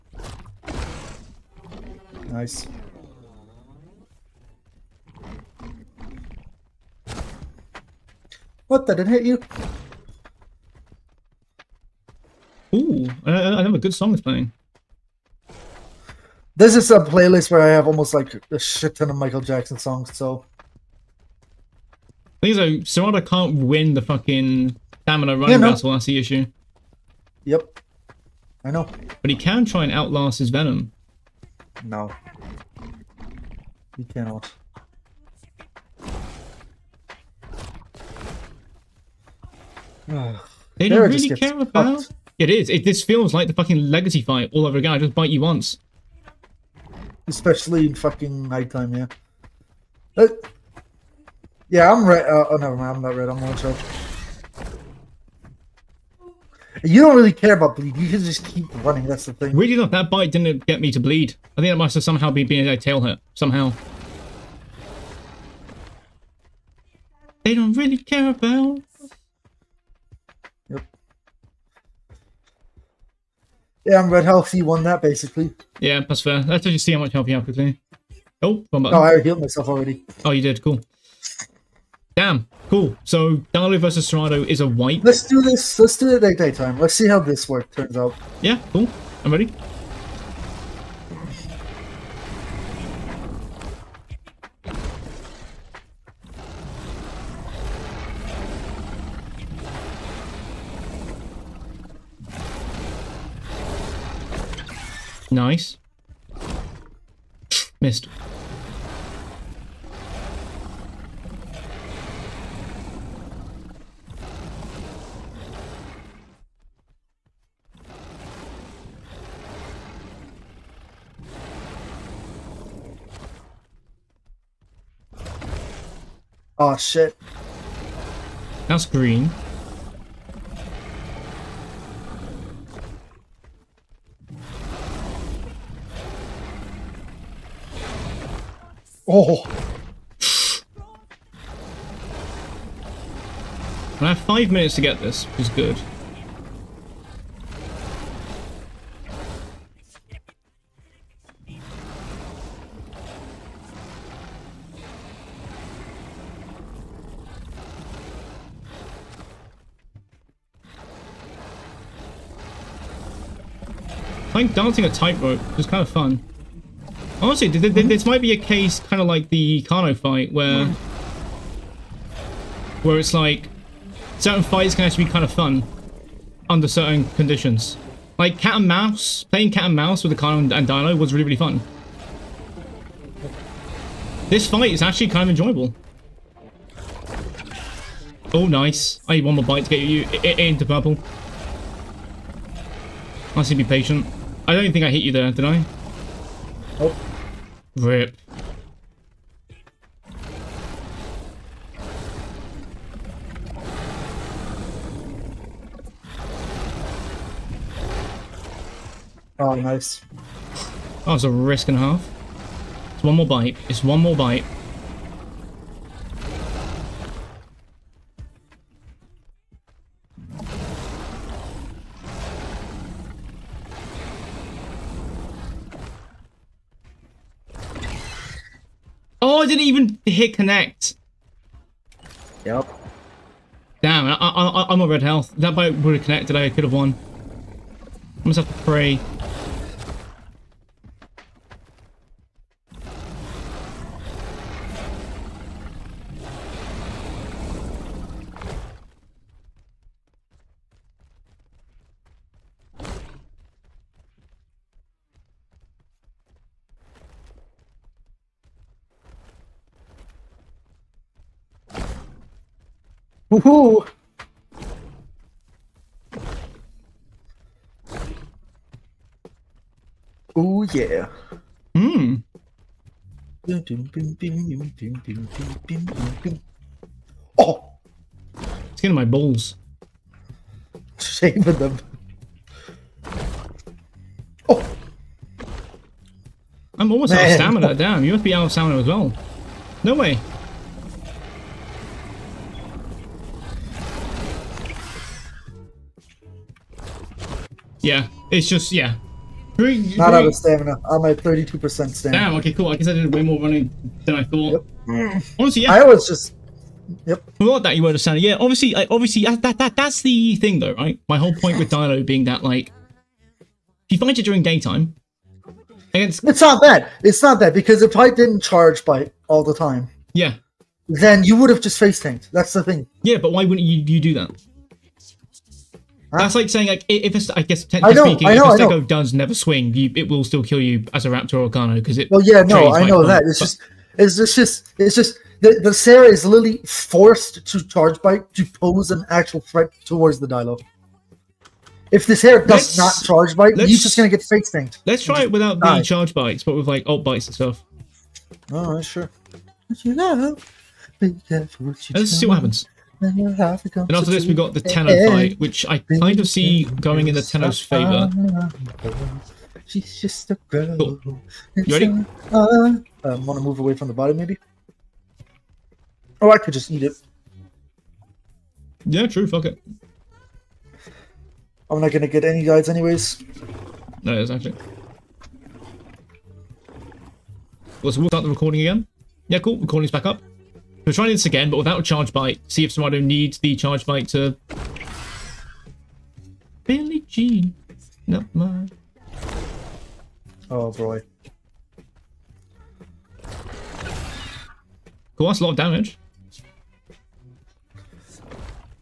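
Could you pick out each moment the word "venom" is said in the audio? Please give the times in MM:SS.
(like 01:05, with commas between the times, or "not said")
00:30.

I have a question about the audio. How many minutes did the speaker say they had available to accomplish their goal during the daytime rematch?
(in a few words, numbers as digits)
5.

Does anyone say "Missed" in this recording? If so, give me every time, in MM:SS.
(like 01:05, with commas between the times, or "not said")
01:47.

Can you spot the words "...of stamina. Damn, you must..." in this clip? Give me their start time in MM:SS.
04:47.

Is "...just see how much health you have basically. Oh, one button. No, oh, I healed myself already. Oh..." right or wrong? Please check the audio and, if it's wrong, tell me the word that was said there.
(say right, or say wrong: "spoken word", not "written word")
wrong: "quickly", not "basically".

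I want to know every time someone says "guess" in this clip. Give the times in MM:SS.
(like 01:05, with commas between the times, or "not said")
05:02, 05:27.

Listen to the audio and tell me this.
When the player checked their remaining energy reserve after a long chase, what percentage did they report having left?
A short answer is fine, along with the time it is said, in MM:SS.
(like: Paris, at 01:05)
32%, at 05:01.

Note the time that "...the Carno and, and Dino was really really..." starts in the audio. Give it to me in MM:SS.
03:00.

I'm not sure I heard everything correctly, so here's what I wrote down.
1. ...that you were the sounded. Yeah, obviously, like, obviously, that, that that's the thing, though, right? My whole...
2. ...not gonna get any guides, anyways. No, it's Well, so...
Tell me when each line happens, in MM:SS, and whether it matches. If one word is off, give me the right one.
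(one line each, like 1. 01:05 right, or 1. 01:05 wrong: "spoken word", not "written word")
1. 05:07 right
2. 06:11 right.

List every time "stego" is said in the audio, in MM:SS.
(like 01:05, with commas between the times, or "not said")
05:28.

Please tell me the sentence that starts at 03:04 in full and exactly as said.
This fight is actually kind of enjoyable.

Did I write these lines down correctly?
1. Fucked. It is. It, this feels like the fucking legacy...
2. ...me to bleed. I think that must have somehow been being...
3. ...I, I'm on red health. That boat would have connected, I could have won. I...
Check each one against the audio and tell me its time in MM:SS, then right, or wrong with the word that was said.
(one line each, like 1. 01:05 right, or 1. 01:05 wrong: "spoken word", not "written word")
1. 00:42 right
2. 01:00 right
3. 03:54 right.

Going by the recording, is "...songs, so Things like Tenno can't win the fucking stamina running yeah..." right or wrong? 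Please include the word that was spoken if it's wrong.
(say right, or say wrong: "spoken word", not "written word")
wrong: "Cerato", not "Tenno".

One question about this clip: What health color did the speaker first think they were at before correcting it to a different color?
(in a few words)
orange.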